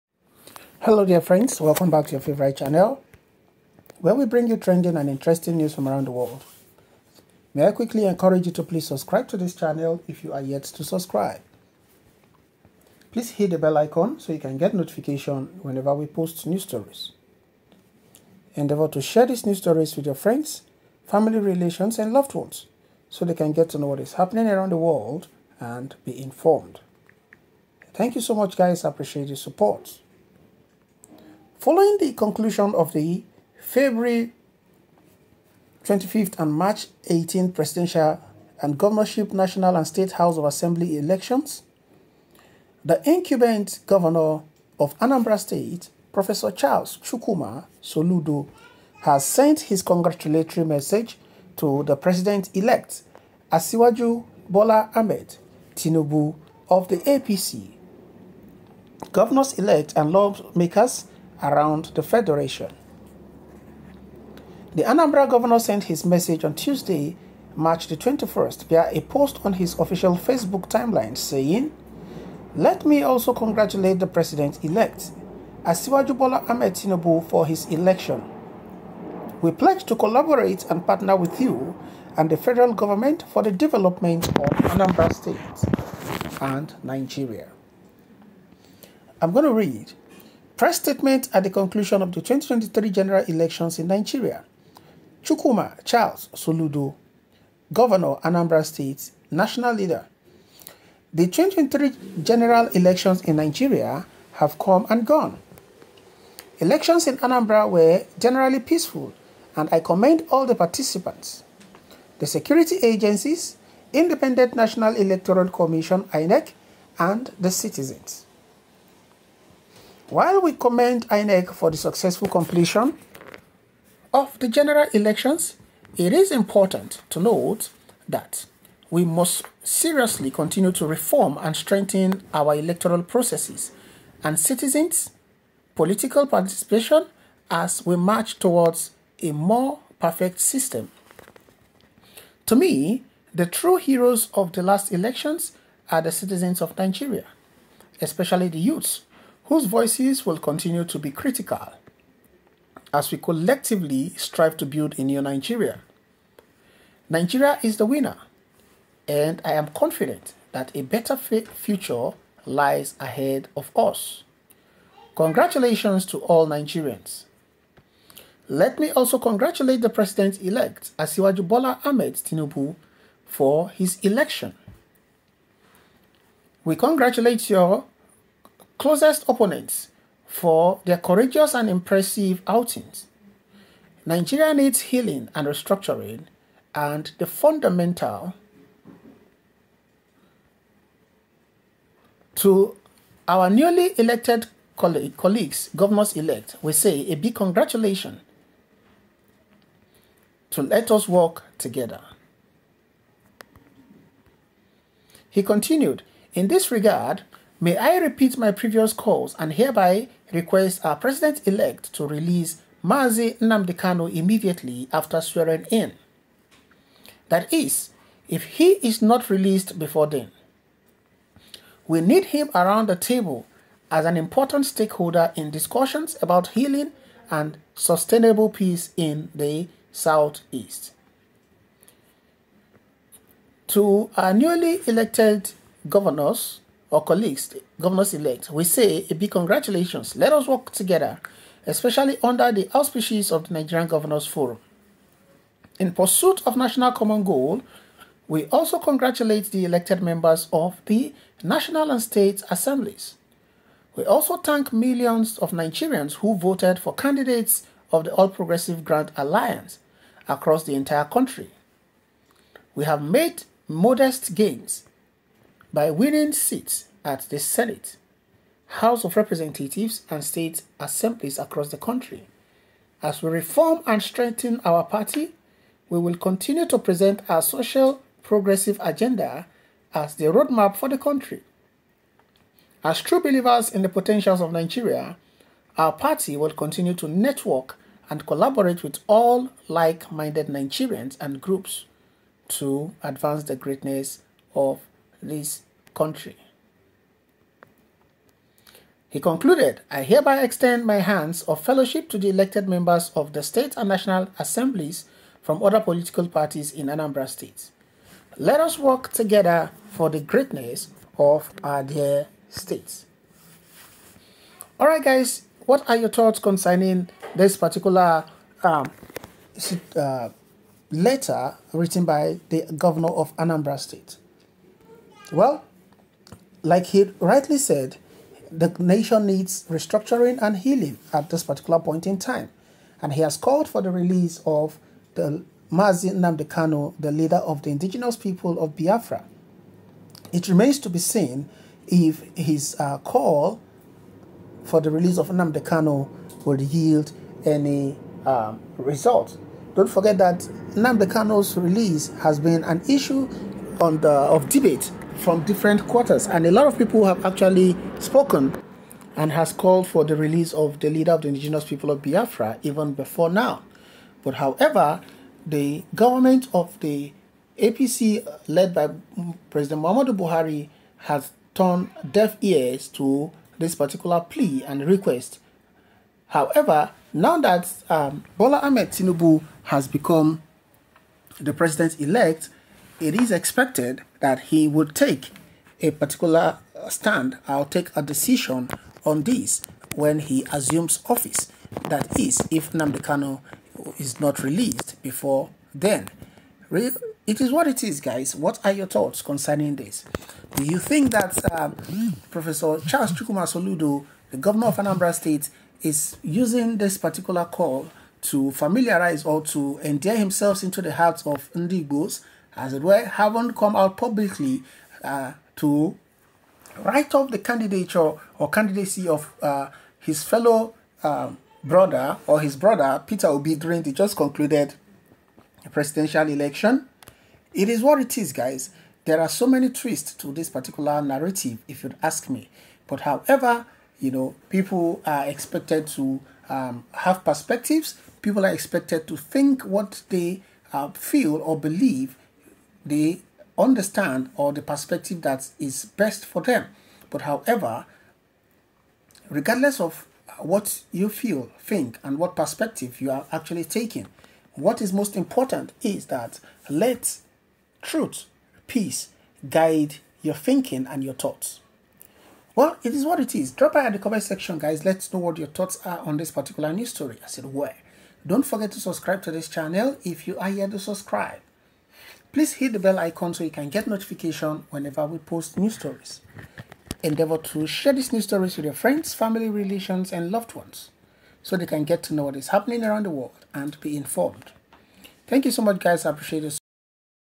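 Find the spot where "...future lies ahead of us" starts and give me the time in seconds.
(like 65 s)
161 s.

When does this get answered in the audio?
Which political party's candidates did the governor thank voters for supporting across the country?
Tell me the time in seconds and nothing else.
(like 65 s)
258 s.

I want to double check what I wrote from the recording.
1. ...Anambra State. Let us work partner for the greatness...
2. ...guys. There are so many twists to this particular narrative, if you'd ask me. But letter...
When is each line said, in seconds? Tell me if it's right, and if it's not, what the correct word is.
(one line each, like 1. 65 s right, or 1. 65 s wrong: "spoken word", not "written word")
1. 306 s wrong: "together", not "partner"
2. 428 s wrong: "however", not "letter".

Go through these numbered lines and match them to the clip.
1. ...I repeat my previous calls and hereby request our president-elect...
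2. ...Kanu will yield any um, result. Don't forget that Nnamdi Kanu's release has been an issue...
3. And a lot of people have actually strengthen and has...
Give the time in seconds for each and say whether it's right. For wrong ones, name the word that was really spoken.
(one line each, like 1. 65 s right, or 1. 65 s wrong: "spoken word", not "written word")
1. 207 s right
2. 345 s right
3. 356 s wrong: "spoken", not "strengthen".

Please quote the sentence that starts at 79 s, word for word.
We pledge to collaborate and partner with you and the federal government for the development of Anambra State and Nigeria.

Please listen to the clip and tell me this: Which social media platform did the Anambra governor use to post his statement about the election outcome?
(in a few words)
Facebook.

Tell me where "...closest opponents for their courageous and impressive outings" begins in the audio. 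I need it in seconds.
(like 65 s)
178 s.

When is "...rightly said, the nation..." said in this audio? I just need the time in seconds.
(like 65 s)
327 s.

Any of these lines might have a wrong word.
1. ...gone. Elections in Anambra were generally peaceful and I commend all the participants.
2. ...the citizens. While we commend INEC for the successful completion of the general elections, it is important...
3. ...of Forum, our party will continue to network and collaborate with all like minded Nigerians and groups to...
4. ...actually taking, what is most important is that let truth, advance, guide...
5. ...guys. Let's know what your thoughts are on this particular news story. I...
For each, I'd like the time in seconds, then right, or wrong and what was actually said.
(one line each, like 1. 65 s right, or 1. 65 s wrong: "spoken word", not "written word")
1. 105 s right
2. 117 s right
3. 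284 s wrong: "Nigeria", not "Forum"
4. 453 s wrong: "peace", not "advance"
5. 464 s right.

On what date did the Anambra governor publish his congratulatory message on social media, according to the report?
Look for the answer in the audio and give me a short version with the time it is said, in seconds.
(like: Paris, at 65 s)
March 21st, at 67 s.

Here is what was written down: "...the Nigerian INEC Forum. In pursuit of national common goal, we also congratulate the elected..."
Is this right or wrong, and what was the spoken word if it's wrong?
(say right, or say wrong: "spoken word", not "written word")
wrong: "Governors", not "INEC".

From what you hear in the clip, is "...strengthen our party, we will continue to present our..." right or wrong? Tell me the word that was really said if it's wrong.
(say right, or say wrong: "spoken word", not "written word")
right.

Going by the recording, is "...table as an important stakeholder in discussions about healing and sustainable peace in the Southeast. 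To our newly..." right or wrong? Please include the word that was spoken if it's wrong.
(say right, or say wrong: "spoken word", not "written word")
right.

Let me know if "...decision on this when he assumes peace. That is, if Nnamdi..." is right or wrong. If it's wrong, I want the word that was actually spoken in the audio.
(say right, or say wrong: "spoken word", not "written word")
wrong: "office", not "peace".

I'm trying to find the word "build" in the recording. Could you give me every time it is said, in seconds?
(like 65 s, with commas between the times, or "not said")
154 s.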